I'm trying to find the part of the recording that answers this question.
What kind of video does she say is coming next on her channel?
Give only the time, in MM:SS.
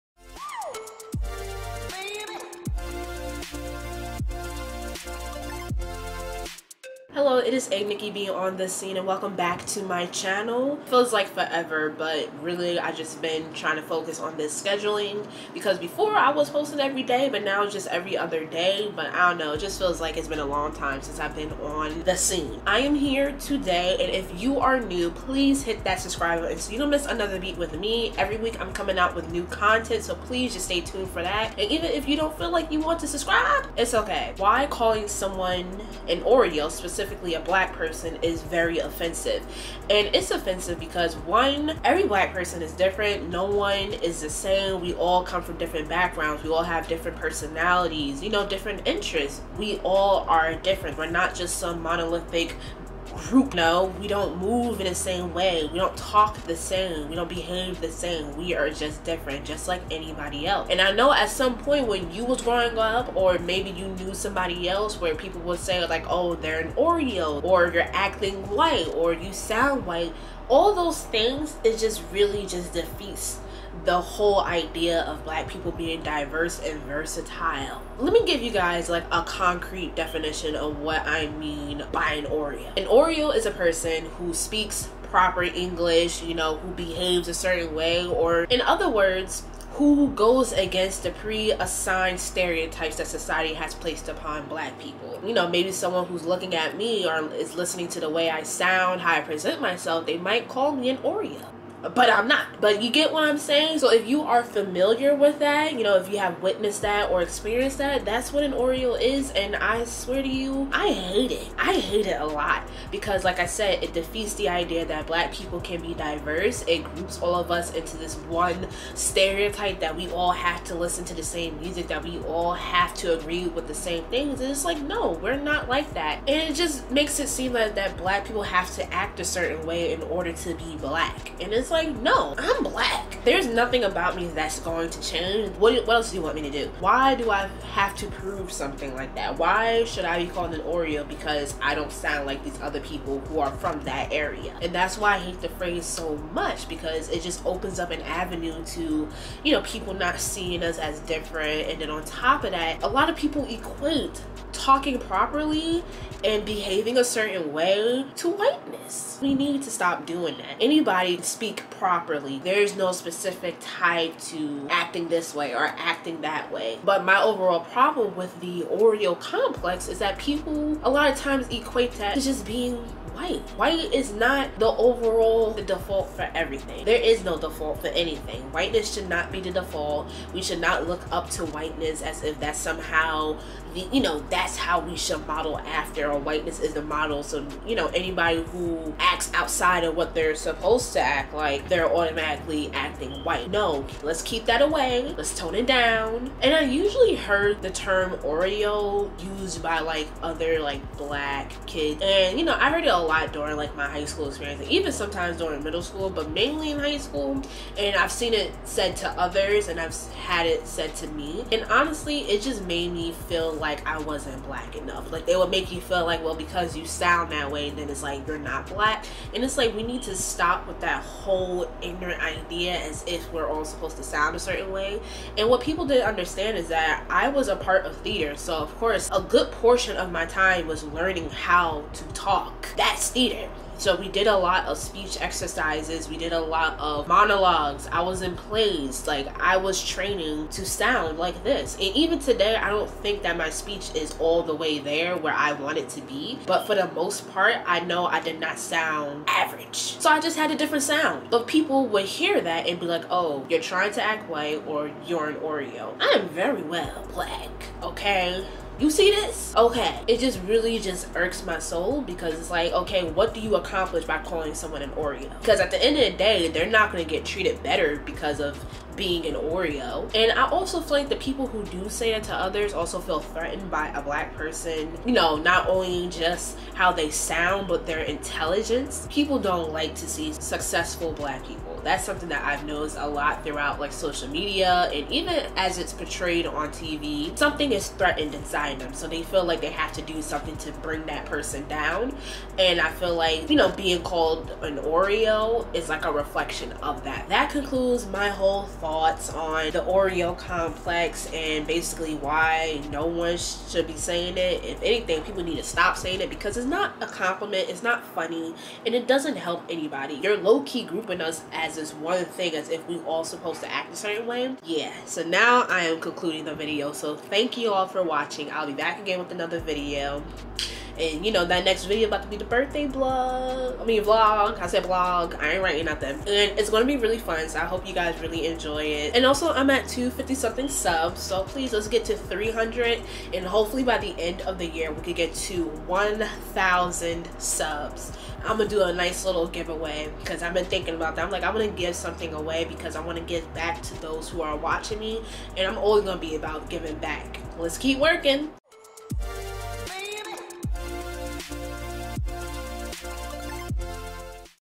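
05:22.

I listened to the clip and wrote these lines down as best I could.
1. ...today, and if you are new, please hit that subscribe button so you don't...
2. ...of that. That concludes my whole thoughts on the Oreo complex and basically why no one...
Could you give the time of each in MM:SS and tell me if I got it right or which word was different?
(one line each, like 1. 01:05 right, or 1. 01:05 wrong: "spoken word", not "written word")
1. 00:23 right
2. 04:56 right.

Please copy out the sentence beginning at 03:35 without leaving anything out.
Like they would make you feel like, well, because you sound that way, then it's like you're not black.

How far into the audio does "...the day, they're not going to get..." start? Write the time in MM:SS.
04:26.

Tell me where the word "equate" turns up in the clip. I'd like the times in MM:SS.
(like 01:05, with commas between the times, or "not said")
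02:33, 02:51.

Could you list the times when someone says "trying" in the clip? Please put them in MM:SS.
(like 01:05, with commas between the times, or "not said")
00:13, 04:13.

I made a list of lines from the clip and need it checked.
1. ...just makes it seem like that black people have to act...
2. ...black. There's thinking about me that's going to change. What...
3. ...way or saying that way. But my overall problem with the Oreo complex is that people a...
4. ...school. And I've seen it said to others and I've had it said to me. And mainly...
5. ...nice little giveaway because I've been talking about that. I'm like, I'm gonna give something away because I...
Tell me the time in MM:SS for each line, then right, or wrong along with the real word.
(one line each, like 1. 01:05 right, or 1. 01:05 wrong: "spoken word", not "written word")
1. 02:06 right
2. 02:12 wrong: "nothing", not "thinking"
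3. 02:45 wrong: "acting", not "saying"
4. 03:26 wrong: "honestly", not "mainly"
5. 05:38 wrong: "thinking", not "talking".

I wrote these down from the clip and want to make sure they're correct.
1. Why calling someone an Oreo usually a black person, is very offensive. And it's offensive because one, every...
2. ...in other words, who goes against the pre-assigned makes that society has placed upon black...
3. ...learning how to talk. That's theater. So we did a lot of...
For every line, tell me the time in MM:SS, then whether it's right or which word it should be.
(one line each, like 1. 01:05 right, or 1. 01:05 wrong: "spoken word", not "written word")
1. 00:34 wrong: "specifically", not "usually"
2. 01:28 wrong: "stereotypes", not "makes"
3. 03:50 right.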